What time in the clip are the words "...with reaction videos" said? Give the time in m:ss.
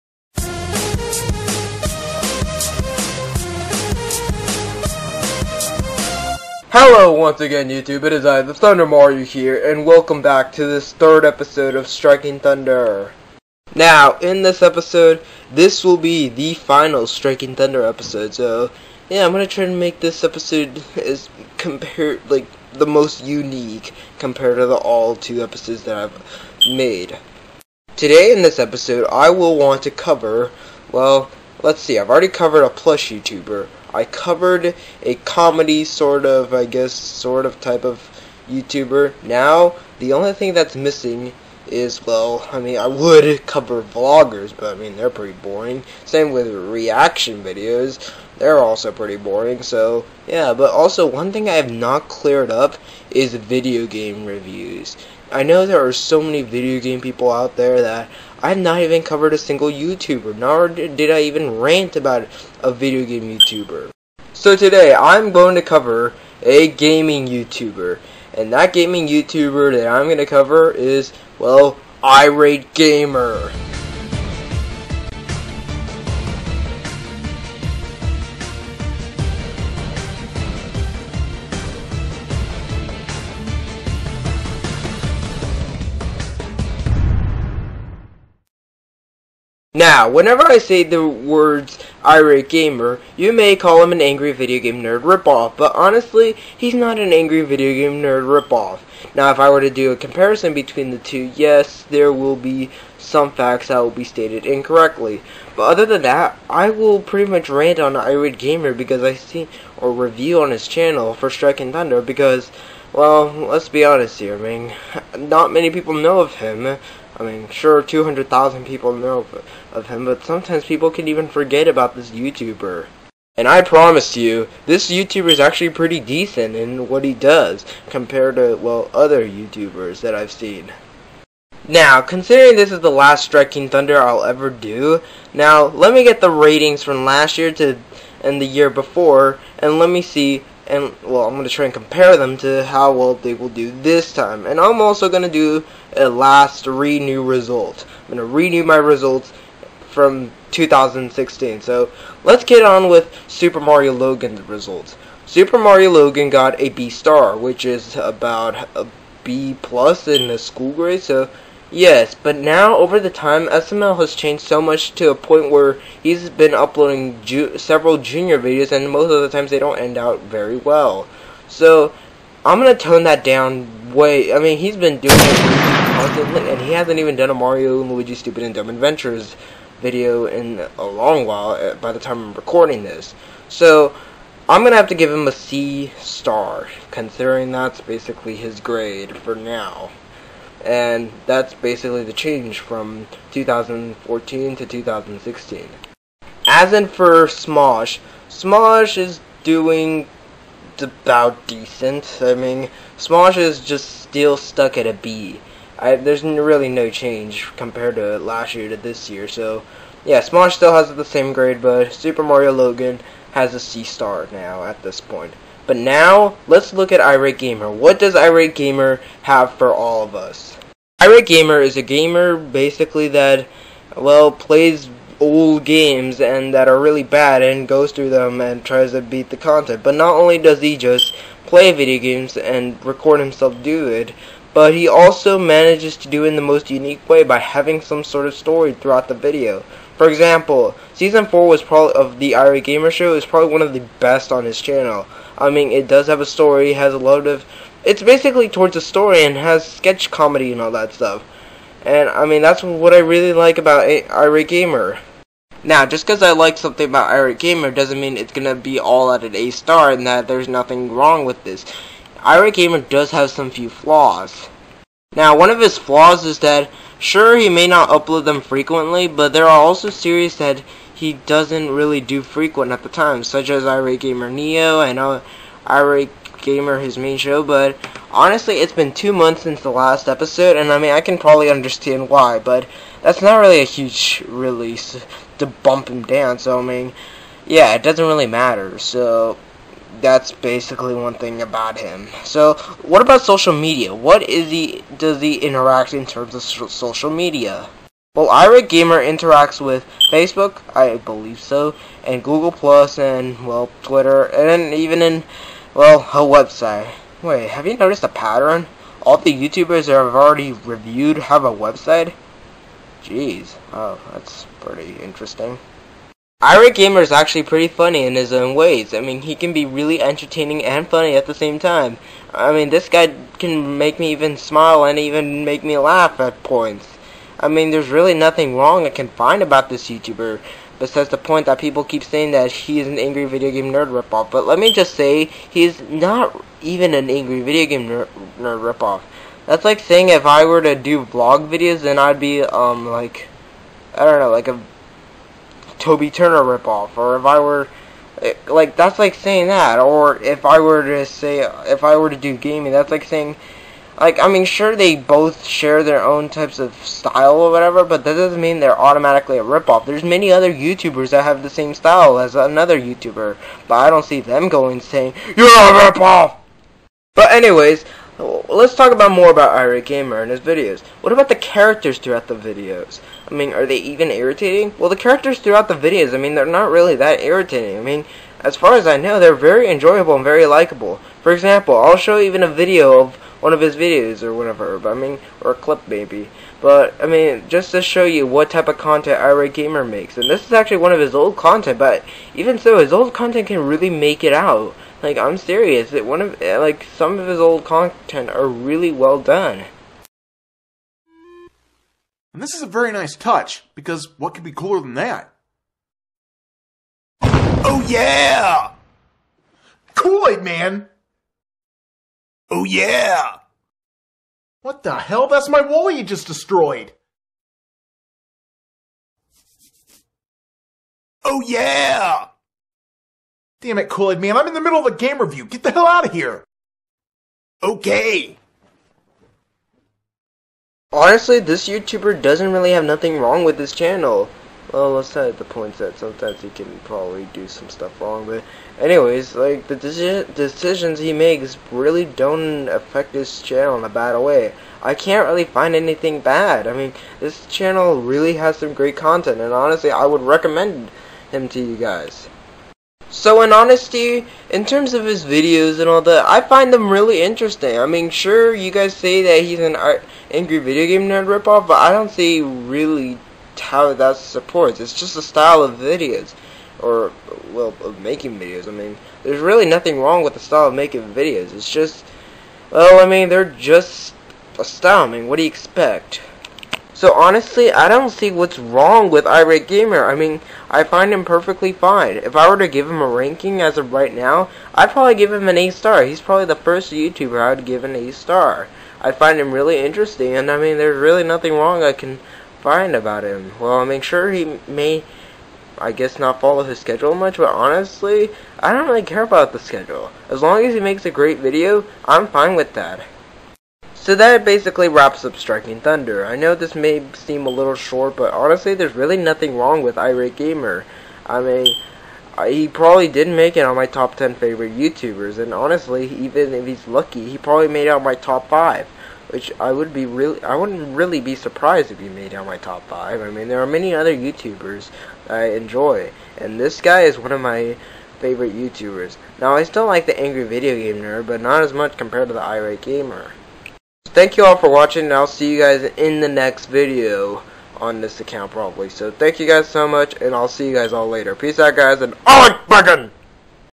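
0:46.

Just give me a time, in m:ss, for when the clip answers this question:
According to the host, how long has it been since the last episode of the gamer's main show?
4:38.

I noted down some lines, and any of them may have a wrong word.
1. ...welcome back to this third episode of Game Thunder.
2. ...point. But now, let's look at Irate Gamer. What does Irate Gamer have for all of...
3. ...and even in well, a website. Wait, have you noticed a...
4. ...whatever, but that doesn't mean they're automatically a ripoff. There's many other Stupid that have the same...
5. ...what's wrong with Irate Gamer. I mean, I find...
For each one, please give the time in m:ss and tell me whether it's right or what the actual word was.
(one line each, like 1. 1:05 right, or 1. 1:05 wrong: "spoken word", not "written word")
1. 0:09 wrong: "Striking", not "Game"
2. 3:34 right
3. 5:04 right
4. 5:57 wrong: "YouTubers", not "Stupid"
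5. 7:58 right.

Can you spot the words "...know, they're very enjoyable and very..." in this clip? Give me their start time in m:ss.
6:18.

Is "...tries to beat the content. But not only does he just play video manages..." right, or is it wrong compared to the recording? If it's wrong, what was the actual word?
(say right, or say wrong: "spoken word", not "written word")
wrong: "games", not "manages".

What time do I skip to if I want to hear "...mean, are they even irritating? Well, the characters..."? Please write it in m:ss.
6:13.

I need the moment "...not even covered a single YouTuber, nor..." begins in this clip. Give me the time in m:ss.
0:58.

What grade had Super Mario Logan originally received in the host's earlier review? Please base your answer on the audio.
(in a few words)
B star.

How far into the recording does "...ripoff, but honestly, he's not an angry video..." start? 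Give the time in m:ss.
1:35.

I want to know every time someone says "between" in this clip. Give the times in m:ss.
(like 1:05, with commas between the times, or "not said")
1:40.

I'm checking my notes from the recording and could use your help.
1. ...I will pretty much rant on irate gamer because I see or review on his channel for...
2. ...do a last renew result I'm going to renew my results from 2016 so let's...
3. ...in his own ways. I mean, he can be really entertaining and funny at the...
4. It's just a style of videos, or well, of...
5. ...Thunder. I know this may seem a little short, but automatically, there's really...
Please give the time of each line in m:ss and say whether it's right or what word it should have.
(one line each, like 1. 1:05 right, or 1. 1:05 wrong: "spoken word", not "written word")
1. 1:46 right
2. 2:25 right
3. 5:18 right
4. 7:44 right
5. 8:25 wrong: "honestly", not "automatically".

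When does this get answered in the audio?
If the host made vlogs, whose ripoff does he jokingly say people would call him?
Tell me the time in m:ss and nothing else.
5:45.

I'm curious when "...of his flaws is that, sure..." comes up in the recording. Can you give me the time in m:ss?
4:25.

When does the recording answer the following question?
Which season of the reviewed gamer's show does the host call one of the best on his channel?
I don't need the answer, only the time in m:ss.
4:00.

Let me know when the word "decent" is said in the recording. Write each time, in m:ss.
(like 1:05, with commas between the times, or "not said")
2:05, 3:21.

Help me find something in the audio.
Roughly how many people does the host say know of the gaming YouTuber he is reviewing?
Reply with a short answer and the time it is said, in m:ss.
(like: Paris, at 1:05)
200,000, at 1:57.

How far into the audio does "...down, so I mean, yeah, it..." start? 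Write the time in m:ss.
4:46.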